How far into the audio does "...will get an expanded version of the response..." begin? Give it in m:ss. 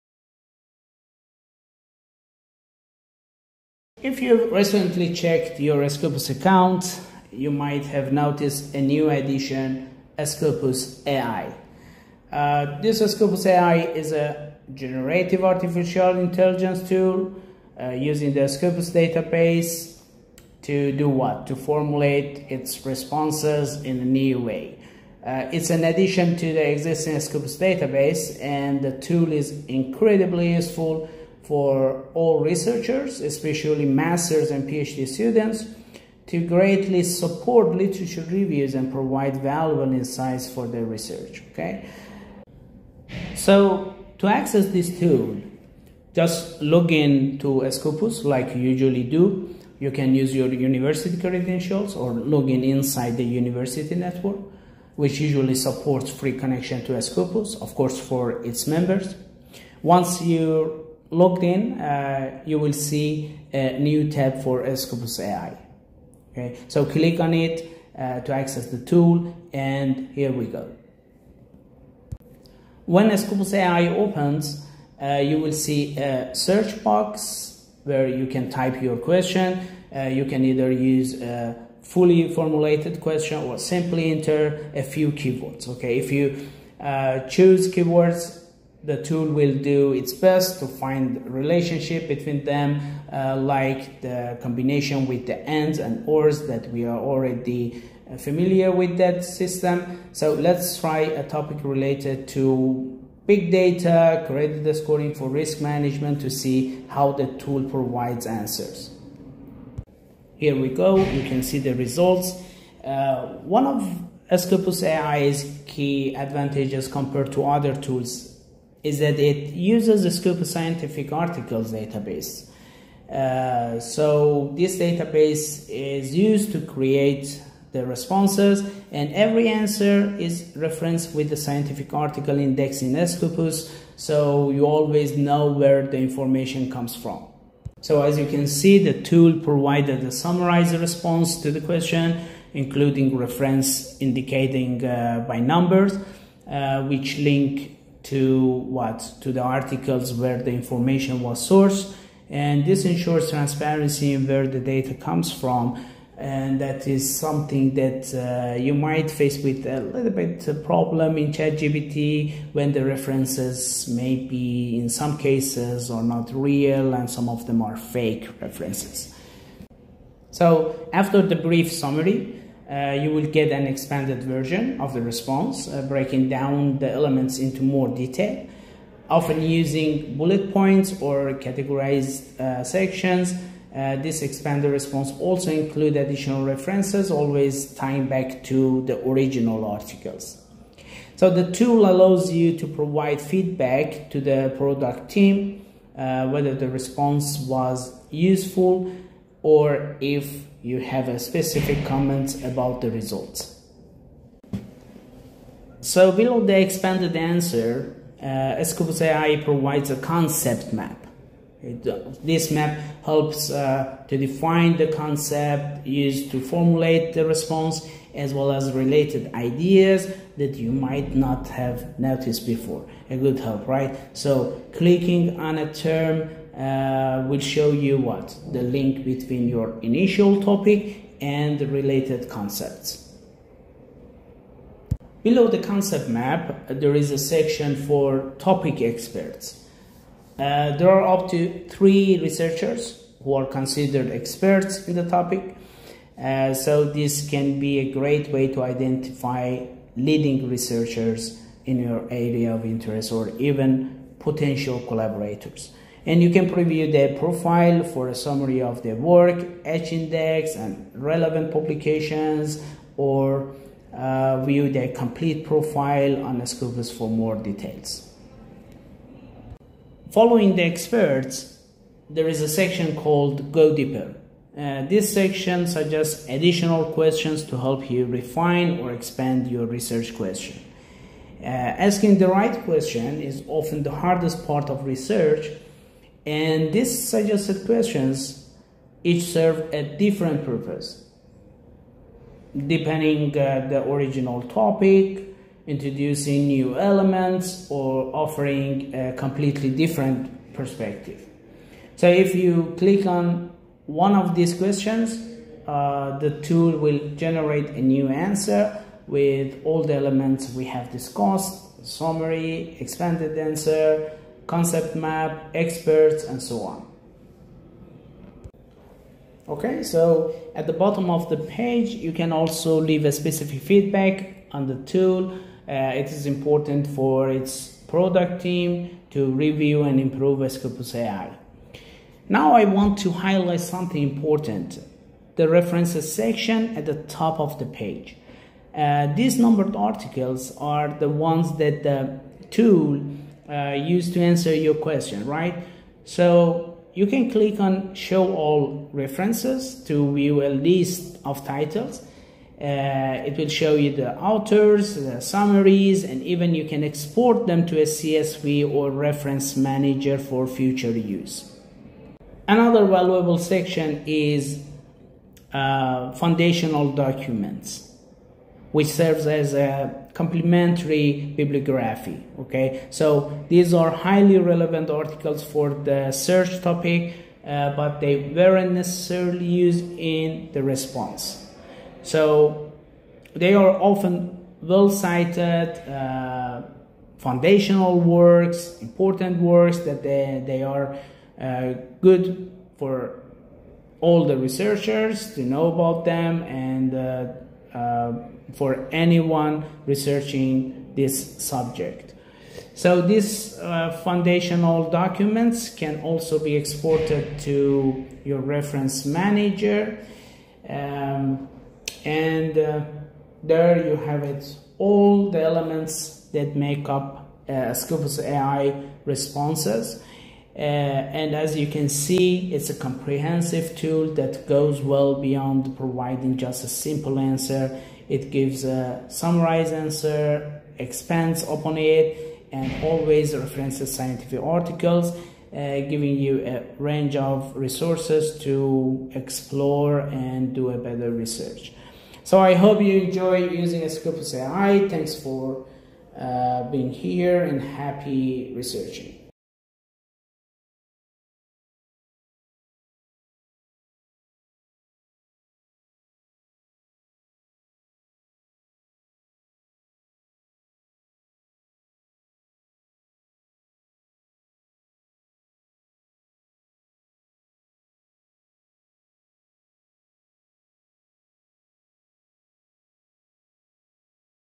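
2:53.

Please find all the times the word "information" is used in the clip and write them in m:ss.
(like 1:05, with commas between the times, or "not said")
2:15, 2:30.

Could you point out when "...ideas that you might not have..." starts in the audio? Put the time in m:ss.
3:39.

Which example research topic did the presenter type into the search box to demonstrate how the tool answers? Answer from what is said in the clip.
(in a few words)
Big data credit scoring for risk management.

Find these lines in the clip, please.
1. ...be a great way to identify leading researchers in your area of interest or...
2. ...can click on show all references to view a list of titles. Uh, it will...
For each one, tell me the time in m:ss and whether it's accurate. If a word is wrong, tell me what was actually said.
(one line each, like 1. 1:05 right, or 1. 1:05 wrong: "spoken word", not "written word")
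1. 4:07 right
2. 5:47 right.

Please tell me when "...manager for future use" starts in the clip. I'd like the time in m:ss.
5:59.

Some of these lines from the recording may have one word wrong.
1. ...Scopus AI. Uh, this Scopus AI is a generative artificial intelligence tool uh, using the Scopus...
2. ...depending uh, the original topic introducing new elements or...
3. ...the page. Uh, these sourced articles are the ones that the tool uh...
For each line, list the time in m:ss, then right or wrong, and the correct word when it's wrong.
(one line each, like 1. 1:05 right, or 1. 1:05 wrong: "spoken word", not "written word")
1. 0:10 right
2. 4:52 right
3. 5:37 wrong: "numbered", not "sourced".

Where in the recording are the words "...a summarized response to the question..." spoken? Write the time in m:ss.
2:20.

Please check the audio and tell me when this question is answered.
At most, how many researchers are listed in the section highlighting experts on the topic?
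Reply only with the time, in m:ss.
4:01.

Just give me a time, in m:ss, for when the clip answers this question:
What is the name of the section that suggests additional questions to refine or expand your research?
4:33.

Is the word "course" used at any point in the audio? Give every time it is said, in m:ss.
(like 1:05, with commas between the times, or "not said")
0:57.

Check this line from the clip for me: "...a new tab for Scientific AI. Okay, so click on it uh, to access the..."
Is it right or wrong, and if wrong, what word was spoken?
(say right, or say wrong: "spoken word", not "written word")
wrong: "Scopus", not "Scientific".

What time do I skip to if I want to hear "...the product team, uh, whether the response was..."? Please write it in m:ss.
3:14.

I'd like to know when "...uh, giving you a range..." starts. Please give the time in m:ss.
7:15.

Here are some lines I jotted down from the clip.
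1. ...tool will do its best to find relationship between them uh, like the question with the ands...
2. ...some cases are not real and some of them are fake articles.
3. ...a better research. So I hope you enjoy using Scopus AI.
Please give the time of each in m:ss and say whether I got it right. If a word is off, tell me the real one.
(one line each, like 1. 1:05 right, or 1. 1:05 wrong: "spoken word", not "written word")
1. 1:29 wrong: "combination", not "question"
2. 2:44 wrong: "references", not "articles"
3. 7:20 right.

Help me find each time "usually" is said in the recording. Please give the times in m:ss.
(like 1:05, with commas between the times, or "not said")
0:48, 0:55.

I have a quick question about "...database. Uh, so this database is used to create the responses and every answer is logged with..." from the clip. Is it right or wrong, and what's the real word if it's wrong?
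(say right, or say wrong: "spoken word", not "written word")
wrong: "referenced", not "logged".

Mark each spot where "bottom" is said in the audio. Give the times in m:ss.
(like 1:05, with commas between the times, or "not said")
5:20.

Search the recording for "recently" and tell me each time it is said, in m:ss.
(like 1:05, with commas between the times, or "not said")
0:04.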